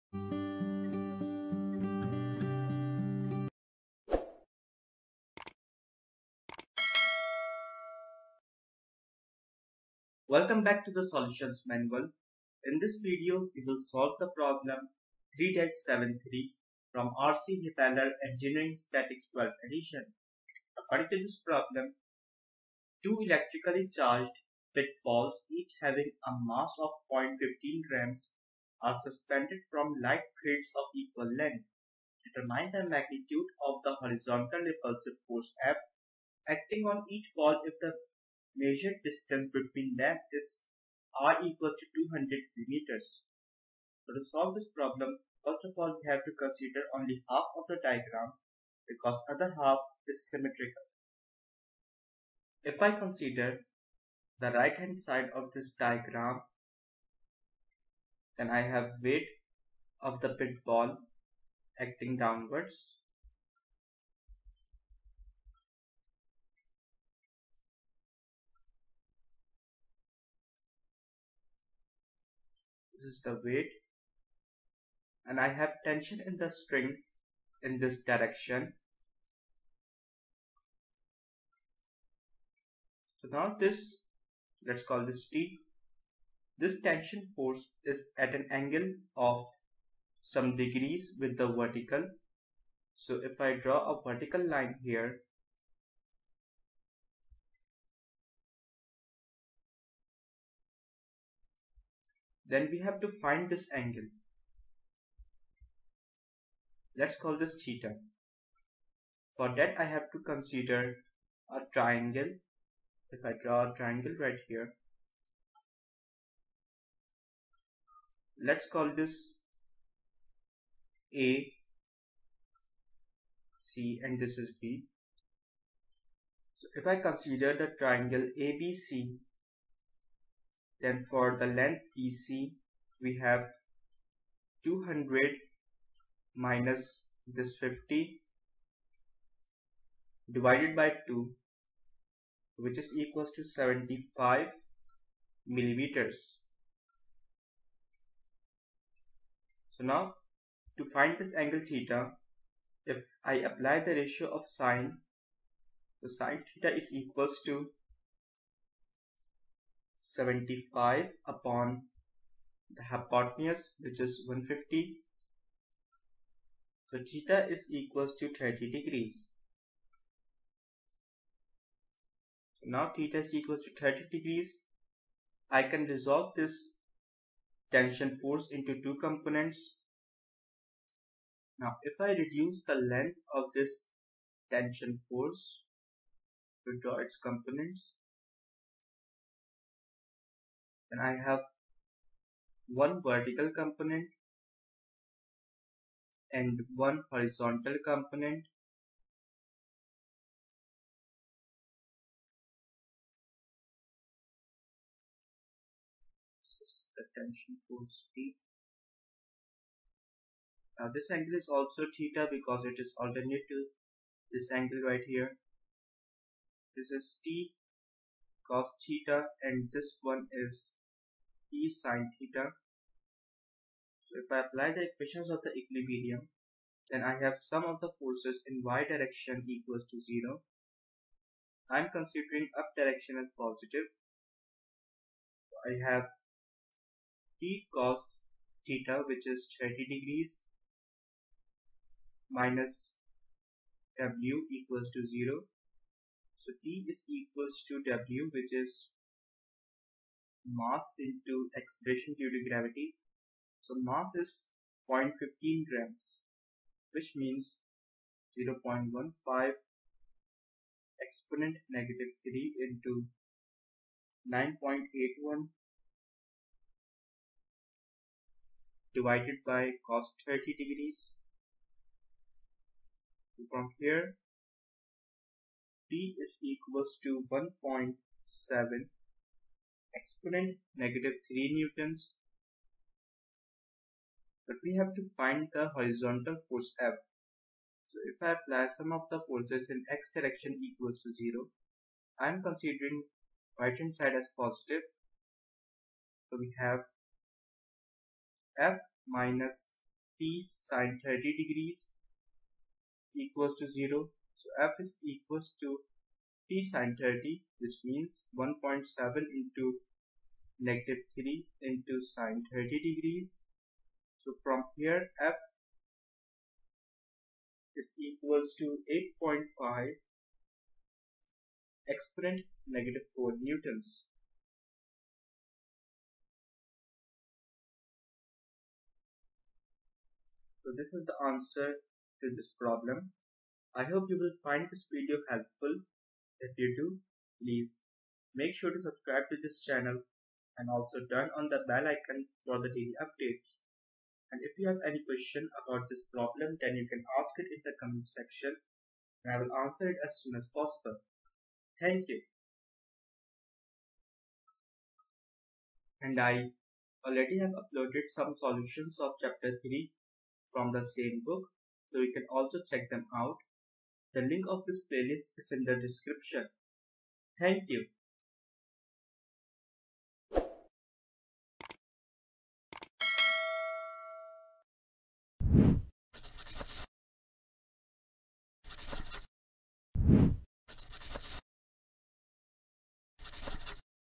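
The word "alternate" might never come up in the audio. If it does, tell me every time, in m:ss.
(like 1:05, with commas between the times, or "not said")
3:32.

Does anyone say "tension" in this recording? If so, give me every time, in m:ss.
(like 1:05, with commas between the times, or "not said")
1:15, 1:26, 2:57, 3:04, 3:27.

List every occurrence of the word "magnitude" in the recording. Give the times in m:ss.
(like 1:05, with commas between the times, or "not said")
0:32.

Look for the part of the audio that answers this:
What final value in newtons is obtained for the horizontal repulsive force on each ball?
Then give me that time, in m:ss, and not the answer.
5:18.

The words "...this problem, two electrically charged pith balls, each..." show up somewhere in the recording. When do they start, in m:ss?
0:21.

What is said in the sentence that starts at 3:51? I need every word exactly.
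I'm considering up direction as positive.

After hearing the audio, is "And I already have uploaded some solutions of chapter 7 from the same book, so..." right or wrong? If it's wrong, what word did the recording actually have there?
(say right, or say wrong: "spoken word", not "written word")
wrong: "3", not "7".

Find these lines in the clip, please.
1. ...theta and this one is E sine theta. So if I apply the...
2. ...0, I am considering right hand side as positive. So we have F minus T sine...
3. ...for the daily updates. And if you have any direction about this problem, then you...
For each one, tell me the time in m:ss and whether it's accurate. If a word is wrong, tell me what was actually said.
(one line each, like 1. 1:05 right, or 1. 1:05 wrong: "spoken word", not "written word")
1. 3:38 right
2. 4:51 right
3. 5:42 wrong: "question", not "direction".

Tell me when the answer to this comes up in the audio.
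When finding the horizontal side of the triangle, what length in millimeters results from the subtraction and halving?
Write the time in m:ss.
2:23.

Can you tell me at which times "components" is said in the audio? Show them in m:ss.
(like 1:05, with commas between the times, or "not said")
2:59, 3:07, 3:13, 3:17.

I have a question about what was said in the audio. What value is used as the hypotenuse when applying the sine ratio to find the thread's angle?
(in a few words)
150.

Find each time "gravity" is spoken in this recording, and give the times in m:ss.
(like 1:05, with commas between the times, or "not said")
4:12.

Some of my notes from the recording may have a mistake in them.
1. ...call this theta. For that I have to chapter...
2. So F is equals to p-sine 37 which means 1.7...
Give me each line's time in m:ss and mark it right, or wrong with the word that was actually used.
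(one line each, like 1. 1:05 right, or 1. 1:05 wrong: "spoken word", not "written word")
1. 1:47 wrong: "consider", not "chapter"
2. 5:04 wrong: "30", not "37".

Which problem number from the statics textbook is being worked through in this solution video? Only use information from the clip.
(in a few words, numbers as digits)
3-73.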